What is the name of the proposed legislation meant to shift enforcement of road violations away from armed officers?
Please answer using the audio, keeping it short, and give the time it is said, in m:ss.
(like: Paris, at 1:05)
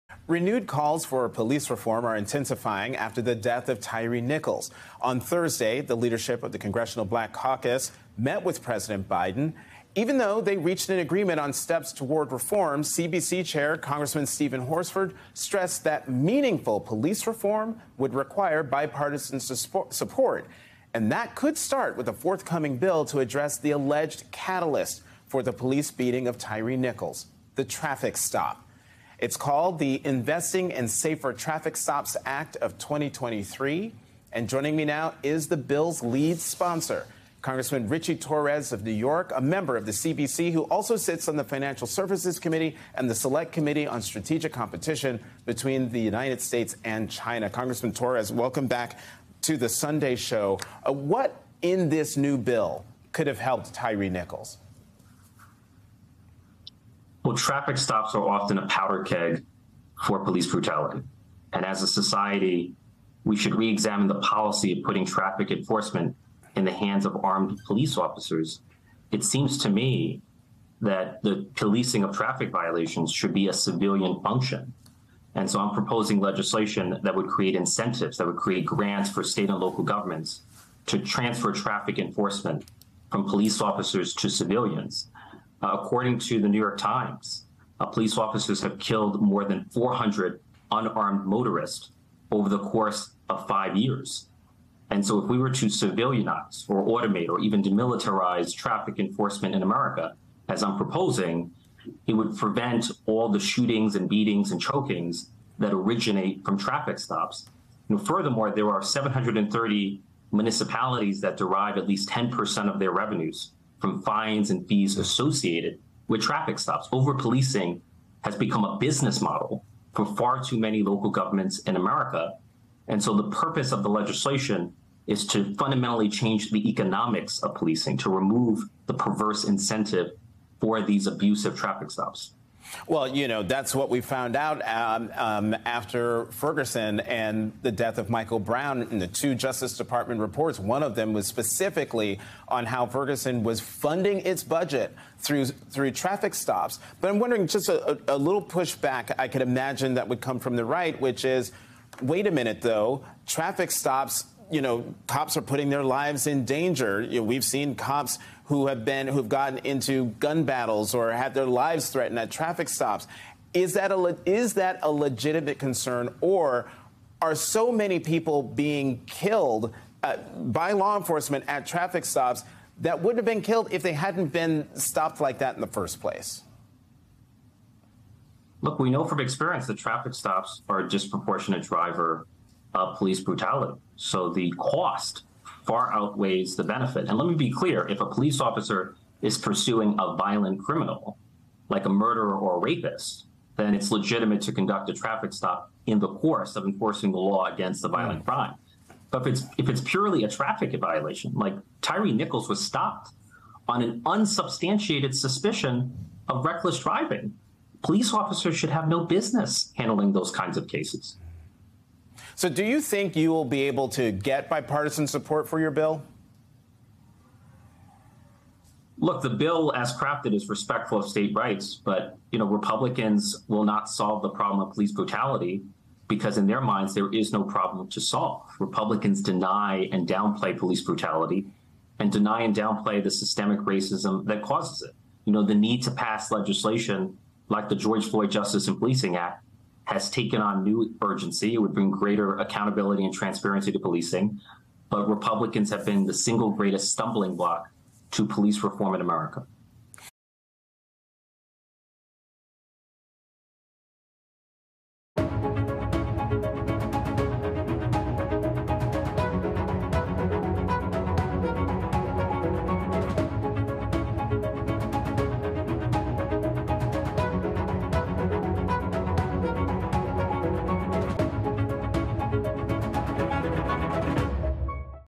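Investing in Safer Traffic Stops Act of 2023, at 0:30.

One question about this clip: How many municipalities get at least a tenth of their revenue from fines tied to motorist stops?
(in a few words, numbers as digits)
730.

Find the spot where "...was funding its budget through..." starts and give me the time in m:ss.
2:23.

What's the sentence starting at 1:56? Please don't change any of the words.
Over policing has become a business model for far too many local governments in America.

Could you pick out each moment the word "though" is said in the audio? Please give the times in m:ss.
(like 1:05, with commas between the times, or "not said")
0:10, 2:32.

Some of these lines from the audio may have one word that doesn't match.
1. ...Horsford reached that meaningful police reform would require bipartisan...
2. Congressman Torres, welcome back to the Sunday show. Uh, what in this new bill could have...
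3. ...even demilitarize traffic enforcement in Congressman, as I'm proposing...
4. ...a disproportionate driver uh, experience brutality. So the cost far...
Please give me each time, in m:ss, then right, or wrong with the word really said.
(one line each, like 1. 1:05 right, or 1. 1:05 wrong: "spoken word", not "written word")
1. 0:14 wrong: "stressed", not "reached"
2. 0:47 right
3. 1:37 wrong: "America", not "Congressman"
4. 3:00 wrong: "police", not "experience".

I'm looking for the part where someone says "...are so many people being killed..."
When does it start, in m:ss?
2:47.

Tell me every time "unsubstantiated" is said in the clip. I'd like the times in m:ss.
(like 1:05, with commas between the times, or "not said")
3:24.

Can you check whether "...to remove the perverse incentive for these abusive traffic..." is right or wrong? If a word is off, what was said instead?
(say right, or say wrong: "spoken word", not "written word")
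right.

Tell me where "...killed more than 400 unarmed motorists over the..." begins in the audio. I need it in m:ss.
1:28.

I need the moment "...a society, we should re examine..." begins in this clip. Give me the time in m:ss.
1:01.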